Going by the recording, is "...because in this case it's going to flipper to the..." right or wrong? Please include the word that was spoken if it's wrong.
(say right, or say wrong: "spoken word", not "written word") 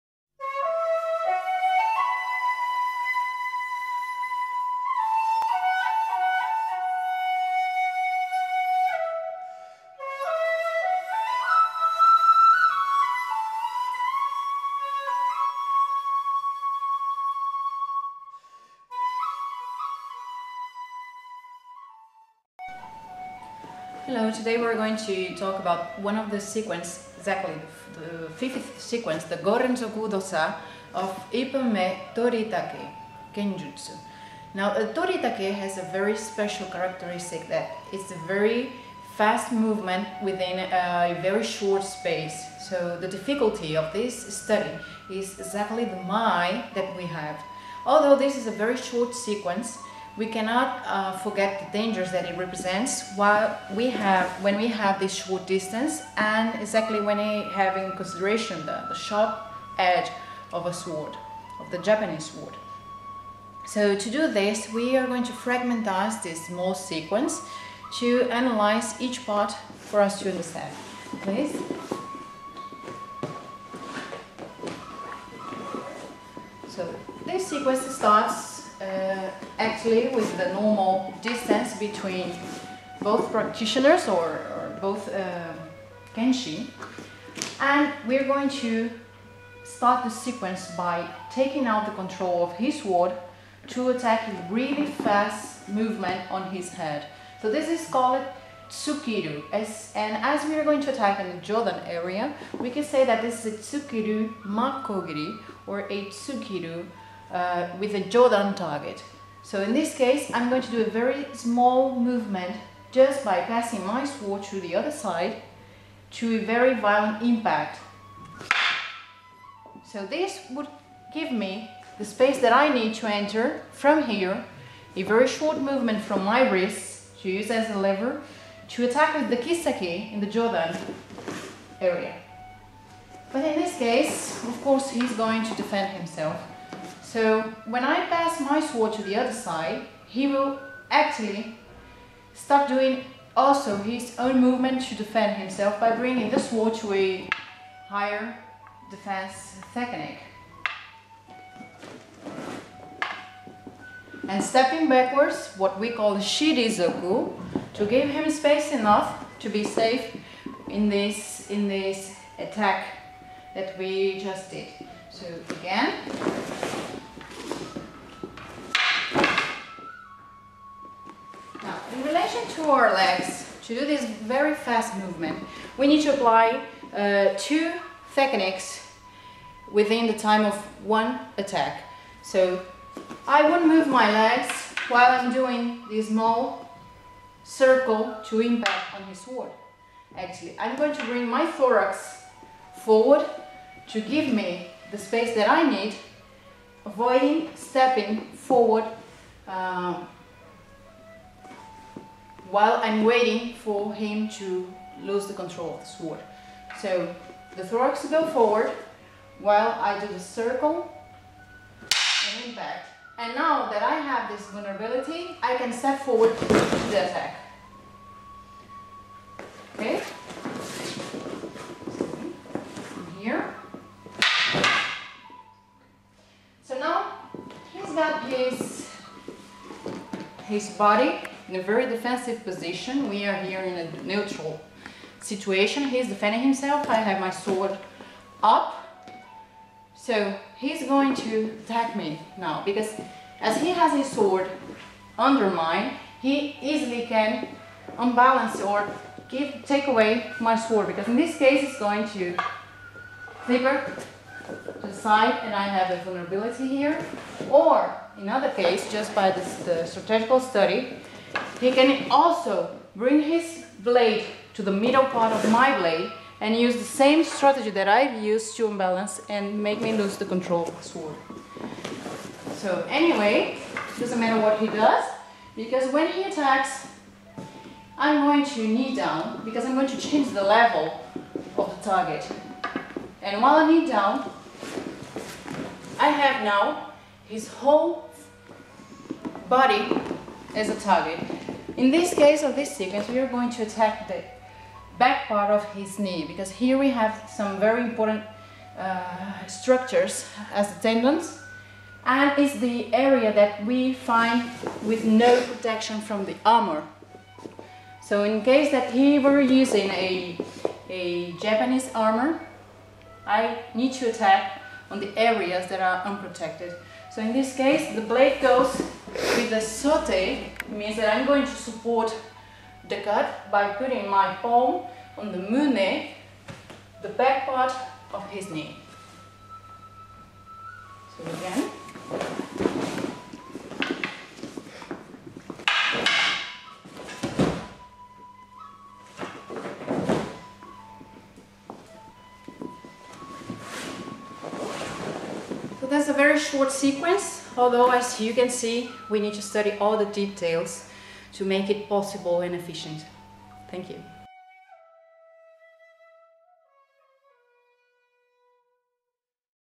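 right.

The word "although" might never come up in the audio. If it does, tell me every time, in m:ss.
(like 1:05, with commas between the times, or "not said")
0:47, 5:47.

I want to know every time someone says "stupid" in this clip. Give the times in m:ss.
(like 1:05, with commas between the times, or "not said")
not said.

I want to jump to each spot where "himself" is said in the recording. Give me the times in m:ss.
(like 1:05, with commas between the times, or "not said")
2:15, 2:25, 3:56.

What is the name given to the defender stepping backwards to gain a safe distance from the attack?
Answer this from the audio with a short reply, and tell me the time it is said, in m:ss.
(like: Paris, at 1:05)
Shirizoku, at 2:36.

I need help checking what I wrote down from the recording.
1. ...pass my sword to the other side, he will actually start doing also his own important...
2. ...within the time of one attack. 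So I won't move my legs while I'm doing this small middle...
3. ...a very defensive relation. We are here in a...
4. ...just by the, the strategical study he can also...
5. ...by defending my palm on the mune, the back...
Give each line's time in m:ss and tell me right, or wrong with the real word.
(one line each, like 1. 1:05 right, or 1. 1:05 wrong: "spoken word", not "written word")
1. 2:18 wrong: "movement", not "important"
2. 2:59 wrong: "circle", not "middle"
3. 3:51 wrong: "position", not "relation"
4. 4:18 right
5. 5:23 wrong: "putting", not "defending".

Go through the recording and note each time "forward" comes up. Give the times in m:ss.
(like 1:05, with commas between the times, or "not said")
3:12, 3:18, 3:28, 3:36.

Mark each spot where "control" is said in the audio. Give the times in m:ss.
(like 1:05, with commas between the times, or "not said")
1:32, 3:25, 4:30.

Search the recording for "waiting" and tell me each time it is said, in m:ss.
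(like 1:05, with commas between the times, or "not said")
3:23.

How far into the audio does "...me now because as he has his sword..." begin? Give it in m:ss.
4:01.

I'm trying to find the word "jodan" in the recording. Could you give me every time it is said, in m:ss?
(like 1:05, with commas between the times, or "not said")
1:41, 1:48, 2:10.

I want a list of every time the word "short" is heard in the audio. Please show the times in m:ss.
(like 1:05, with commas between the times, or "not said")
0:41, 0:48, 0:55, 2:05, 5:46.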